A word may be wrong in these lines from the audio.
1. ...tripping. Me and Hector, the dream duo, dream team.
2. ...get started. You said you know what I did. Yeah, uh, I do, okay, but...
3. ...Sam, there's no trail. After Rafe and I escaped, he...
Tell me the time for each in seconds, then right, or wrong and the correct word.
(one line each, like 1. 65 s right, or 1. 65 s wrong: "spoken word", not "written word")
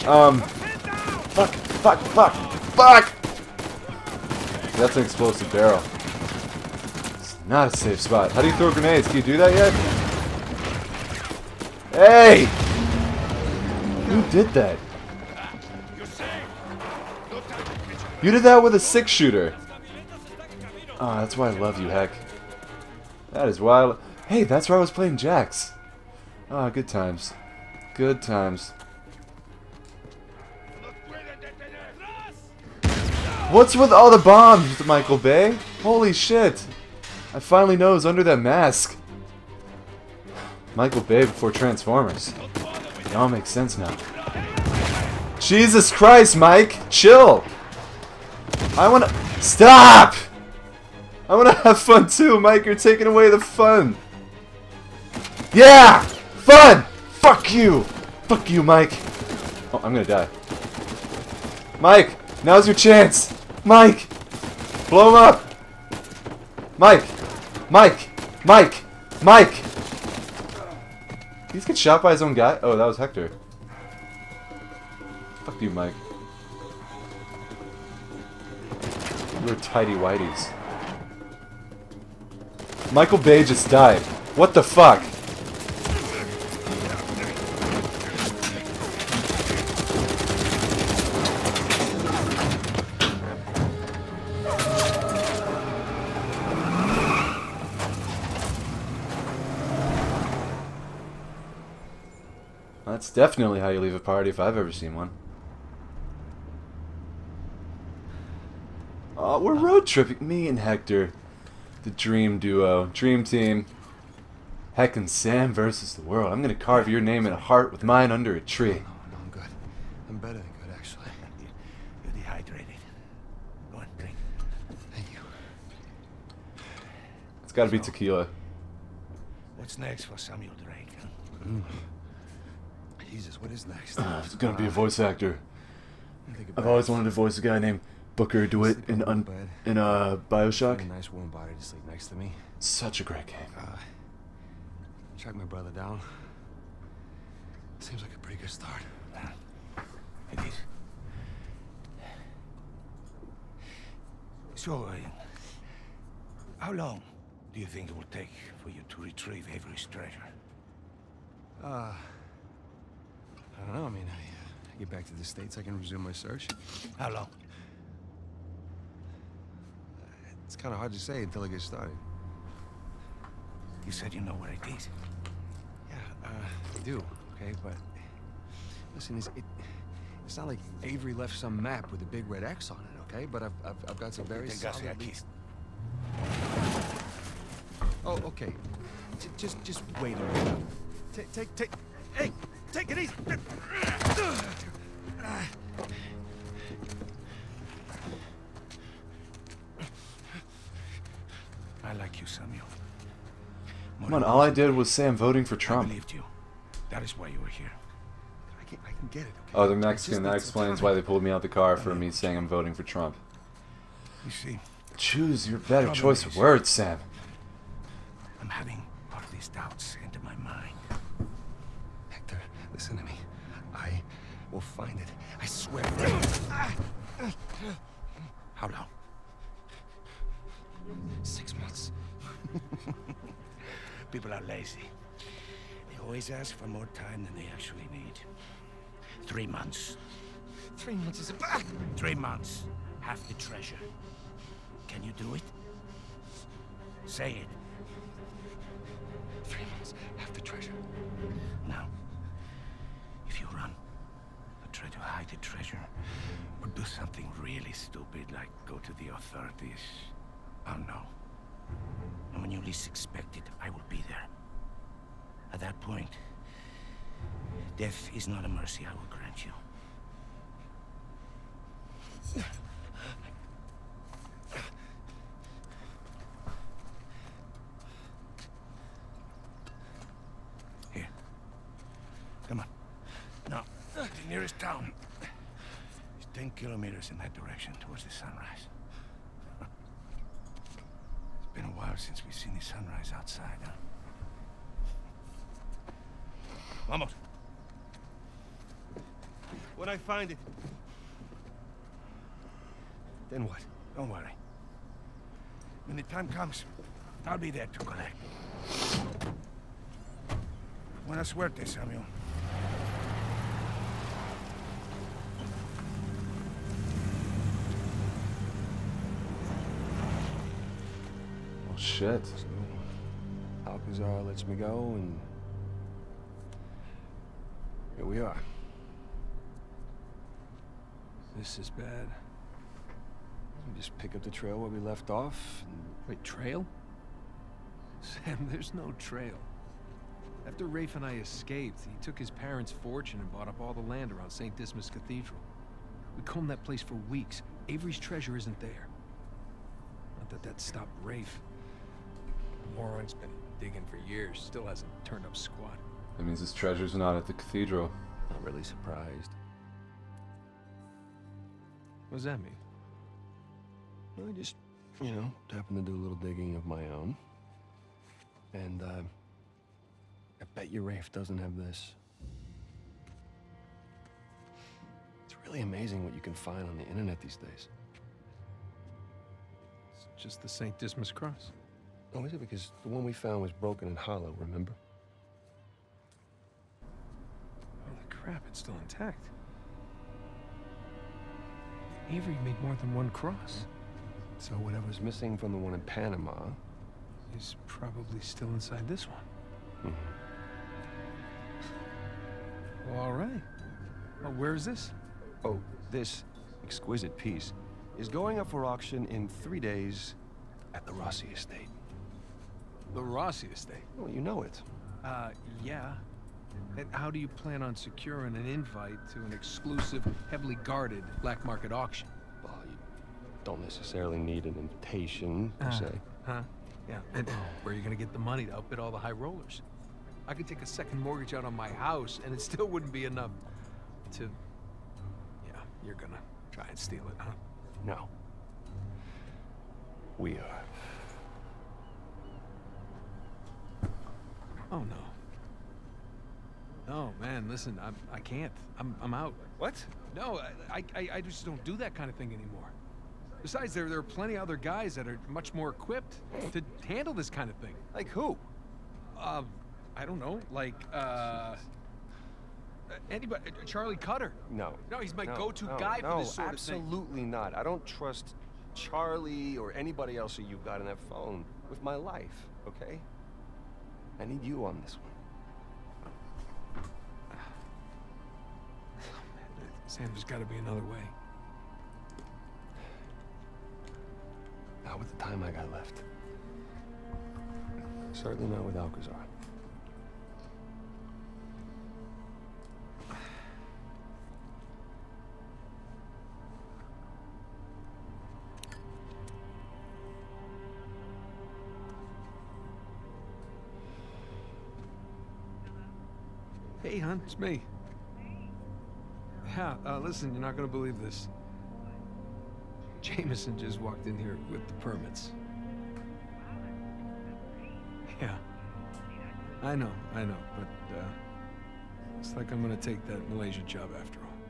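1. 109 s right
2. 171 s right
3. 338 s right.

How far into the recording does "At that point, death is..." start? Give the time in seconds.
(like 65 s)
265 s.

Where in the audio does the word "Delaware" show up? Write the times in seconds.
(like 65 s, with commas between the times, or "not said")
not said.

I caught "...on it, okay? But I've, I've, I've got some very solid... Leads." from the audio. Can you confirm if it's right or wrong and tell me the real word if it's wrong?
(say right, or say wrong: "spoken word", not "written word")
right.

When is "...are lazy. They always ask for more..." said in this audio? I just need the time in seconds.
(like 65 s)
234 s.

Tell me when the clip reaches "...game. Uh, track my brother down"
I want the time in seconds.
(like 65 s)
143 s.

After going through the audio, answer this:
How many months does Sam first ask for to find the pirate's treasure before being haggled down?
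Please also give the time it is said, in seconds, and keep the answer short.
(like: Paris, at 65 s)
6, at 231 s.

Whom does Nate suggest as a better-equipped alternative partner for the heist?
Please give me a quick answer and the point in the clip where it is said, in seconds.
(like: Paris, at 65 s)
Charlie Cutter, at 463 s.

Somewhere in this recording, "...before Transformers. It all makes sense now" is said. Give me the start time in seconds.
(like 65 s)
41 s.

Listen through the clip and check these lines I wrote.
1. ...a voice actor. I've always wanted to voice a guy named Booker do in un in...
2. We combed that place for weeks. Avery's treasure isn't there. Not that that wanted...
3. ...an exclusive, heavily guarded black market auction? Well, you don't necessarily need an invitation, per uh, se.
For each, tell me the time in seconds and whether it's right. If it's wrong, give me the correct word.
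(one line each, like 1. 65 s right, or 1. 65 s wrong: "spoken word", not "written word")
1. 134 s right
2. 346 s wrong: "stopped", not "wanted"
3. 419 s right.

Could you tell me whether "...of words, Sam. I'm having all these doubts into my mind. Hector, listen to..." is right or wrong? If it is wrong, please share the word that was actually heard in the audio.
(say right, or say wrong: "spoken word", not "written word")
right.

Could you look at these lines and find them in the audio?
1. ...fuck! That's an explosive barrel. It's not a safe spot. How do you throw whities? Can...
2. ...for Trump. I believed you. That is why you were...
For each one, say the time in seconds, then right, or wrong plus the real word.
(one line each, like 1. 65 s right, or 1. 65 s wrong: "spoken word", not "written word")
1. 2 s wrong: "grenades", not "whities"
2. 205 s right.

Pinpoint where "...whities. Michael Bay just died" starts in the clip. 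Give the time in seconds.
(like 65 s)
79 s.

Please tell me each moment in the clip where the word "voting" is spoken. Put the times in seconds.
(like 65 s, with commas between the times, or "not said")
205 s, 212 s.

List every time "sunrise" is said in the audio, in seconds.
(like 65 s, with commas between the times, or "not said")
288 s, 292 s.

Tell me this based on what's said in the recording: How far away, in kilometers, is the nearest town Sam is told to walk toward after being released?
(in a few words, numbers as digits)
10.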